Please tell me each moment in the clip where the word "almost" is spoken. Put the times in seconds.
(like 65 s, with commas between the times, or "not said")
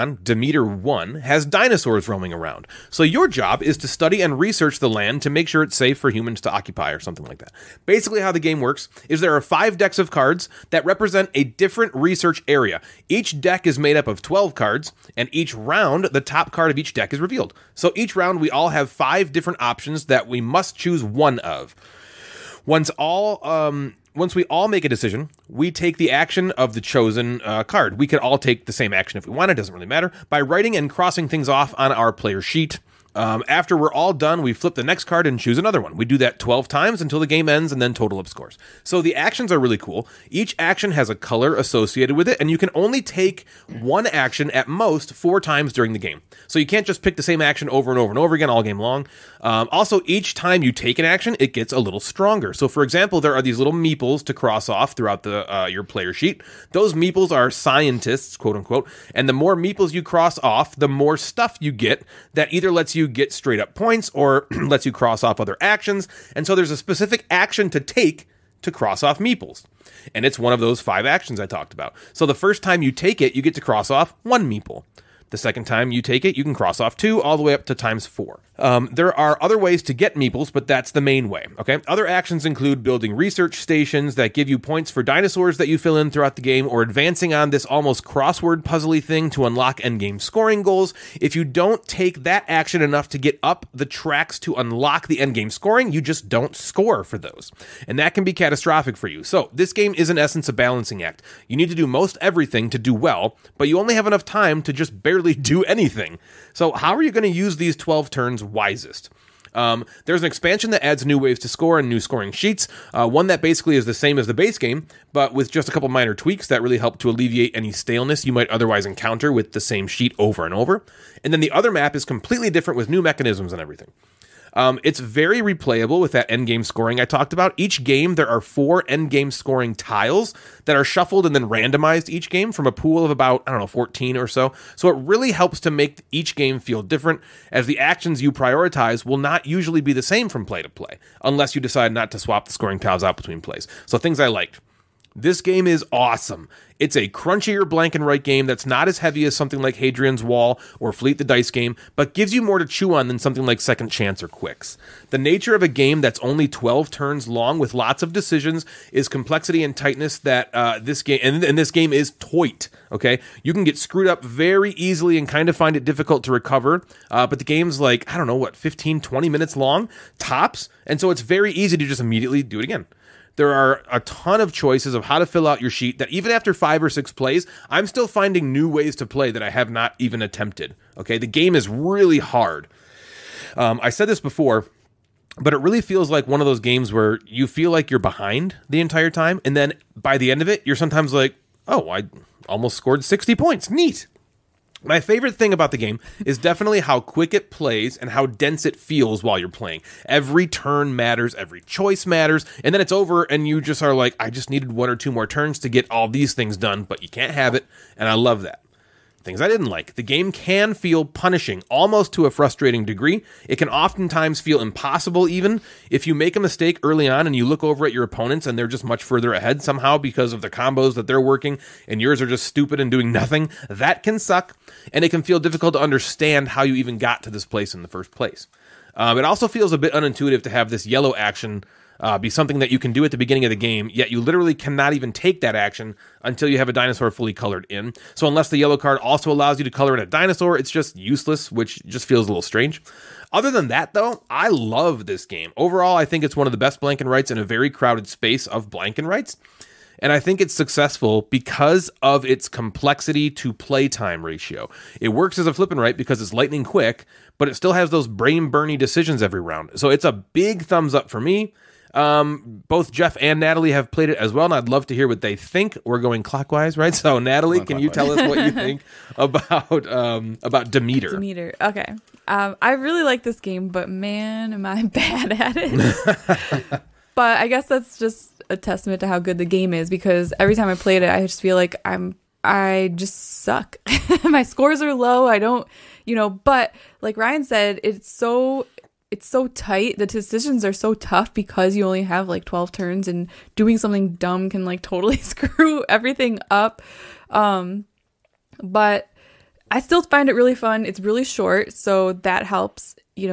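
87 s, 192 s, 211 s.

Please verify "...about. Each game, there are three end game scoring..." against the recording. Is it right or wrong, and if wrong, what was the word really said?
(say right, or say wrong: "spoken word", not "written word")
wrong: "four", not "three".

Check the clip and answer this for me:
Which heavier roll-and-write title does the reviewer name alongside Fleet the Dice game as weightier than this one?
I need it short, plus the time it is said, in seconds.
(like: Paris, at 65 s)
Hadrian's Wall, at 149 s.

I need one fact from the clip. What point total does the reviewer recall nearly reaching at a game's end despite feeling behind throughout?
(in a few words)
60.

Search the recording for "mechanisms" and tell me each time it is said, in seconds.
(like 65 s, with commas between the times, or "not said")
123 s.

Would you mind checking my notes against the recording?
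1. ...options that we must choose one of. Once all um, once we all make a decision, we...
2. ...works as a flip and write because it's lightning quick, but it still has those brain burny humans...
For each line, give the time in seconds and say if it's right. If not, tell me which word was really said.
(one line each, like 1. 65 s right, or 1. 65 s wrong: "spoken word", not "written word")
1. 19 s right
2. 255 s wrong: "decisions", not "humans".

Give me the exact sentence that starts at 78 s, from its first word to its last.
Um, there are other ways to get meeples, but that's the main way.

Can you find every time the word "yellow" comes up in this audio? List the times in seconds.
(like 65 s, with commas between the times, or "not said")
230 s, 238 s.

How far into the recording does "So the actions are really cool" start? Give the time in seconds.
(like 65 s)
38 s.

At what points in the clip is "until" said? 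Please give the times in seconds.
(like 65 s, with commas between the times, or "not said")
37 s, 236 s.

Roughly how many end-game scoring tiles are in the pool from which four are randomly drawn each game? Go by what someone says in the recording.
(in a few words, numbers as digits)
14.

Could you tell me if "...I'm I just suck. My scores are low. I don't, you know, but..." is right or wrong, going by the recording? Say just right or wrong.
right.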